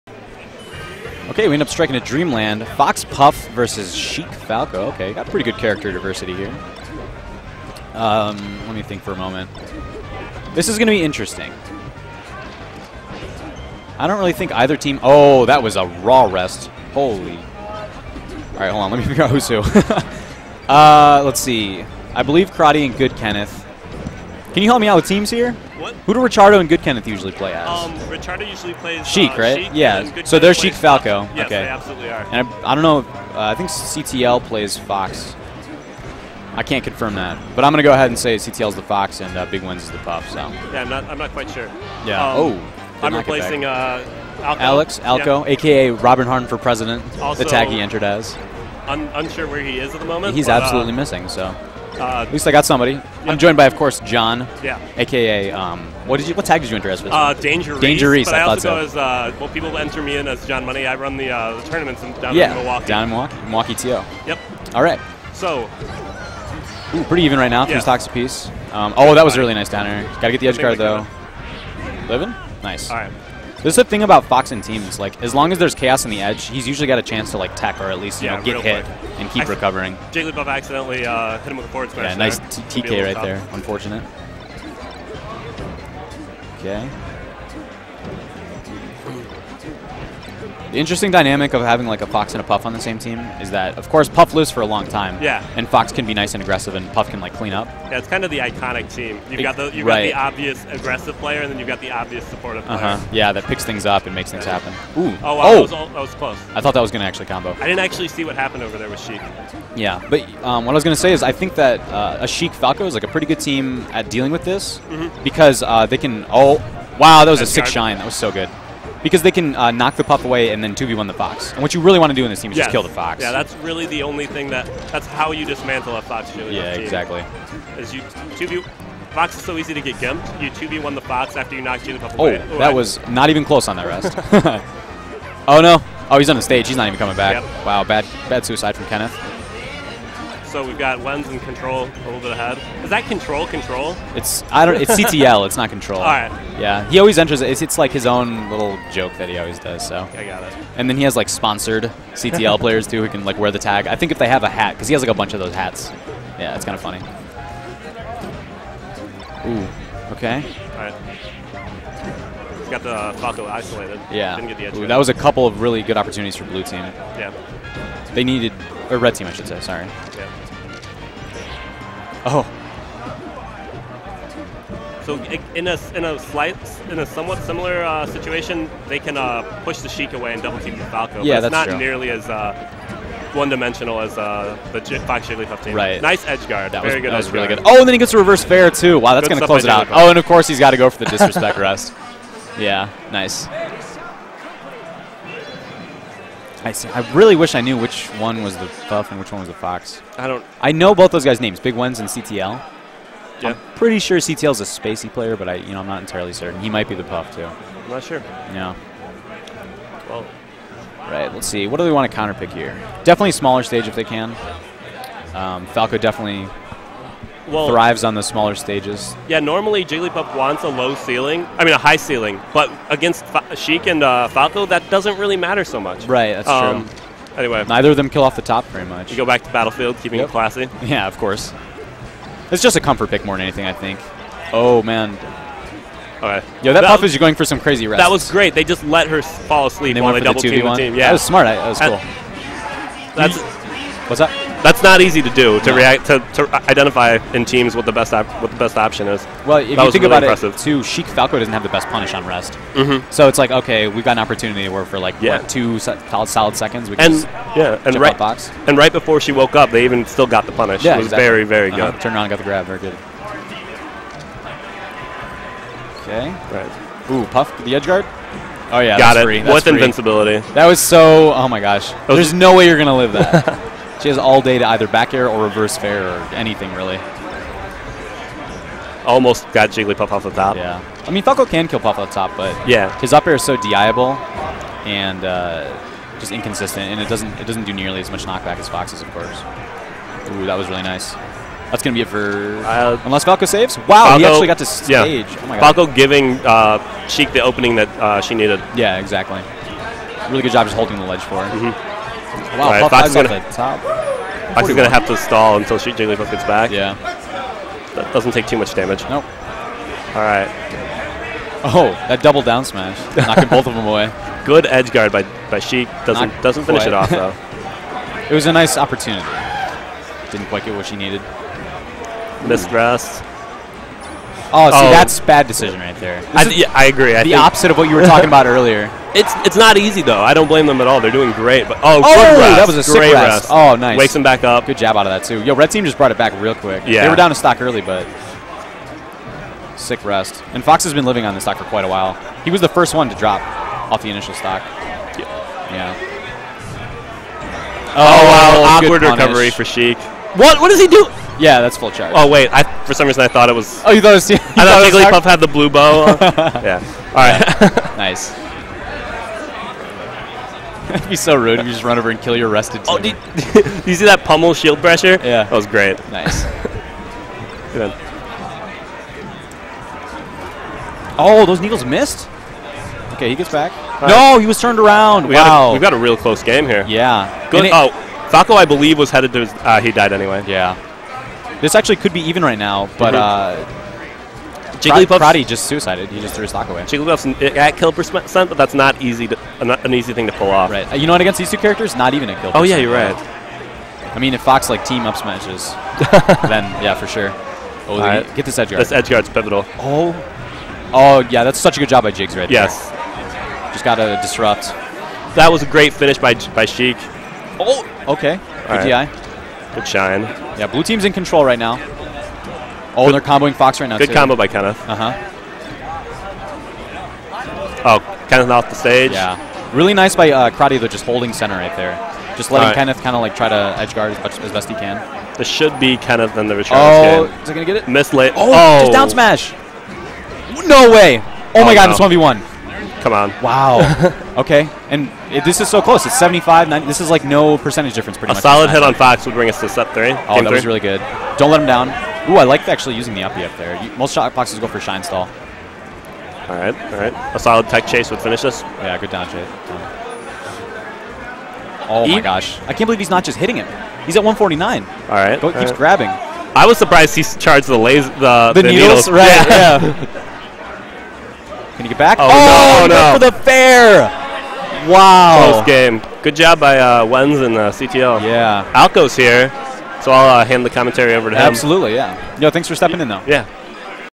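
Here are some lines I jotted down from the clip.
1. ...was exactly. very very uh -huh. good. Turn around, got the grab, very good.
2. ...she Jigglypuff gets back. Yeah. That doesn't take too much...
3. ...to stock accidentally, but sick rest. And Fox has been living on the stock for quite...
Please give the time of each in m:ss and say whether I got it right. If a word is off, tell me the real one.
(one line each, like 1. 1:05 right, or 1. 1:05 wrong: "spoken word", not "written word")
1. 4:21 right
2. 5:05 right
3. 5:37 wrong: "early", not "accidentally".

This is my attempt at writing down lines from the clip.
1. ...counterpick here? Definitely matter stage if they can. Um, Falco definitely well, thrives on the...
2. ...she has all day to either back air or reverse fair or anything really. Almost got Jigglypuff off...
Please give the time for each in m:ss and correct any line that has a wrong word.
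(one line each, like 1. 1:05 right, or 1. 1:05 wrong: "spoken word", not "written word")
1. 3:32 wrong: "smaller", not "matter"
2. 4:34 right.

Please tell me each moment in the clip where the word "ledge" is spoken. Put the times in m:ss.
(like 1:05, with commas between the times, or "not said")
5:01.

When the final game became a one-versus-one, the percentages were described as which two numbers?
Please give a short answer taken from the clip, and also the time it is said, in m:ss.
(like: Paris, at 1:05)
75 and 90, at 7:16.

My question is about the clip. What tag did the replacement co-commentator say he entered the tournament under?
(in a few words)
Danger Danger.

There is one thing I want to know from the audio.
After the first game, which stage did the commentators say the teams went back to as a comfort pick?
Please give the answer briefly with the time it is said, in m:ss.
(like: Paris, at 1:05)
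Battlefield, at 3:49.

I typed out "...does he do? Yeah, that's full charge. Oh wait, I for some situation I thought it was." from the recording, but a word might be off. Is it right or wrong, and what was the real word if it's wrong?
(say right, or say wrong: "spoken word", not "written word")
wrong: "reason", not "situation".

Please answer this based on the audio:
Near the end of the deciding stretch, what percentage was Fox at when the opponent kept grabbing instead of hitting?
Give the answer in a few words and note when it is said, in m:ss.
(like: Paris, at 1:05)
149, at 7:34.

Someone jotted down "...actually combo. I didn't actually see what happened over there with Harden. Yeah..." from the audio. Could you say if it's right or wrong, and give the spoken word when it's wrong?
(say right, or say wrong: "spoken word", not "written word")
wrong: "Sheik", not "Harden".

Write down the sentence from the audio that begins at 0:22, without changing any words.
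I believe Kradi and Good Kenneth.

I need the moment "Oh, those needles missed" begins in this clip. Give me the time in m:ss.
6:11.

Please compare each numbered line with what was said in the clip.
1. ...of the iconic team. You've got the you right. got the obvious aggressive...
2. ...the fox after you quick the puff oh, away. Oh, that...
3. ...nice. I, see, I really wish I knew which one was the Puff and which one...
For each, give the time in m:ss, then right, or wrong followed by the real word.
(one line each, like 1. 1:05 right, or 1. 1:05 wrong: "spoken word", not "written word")
1. 1:38 right
2. 2:10 wrong: "knock", not "quick"
3. 3:13 right.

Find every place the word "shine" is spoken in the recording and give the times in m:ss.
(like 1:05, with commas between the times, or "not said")
1:57, 6:49, 7:24.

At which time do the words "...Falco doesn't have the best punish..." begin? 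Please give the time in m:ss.
4:11.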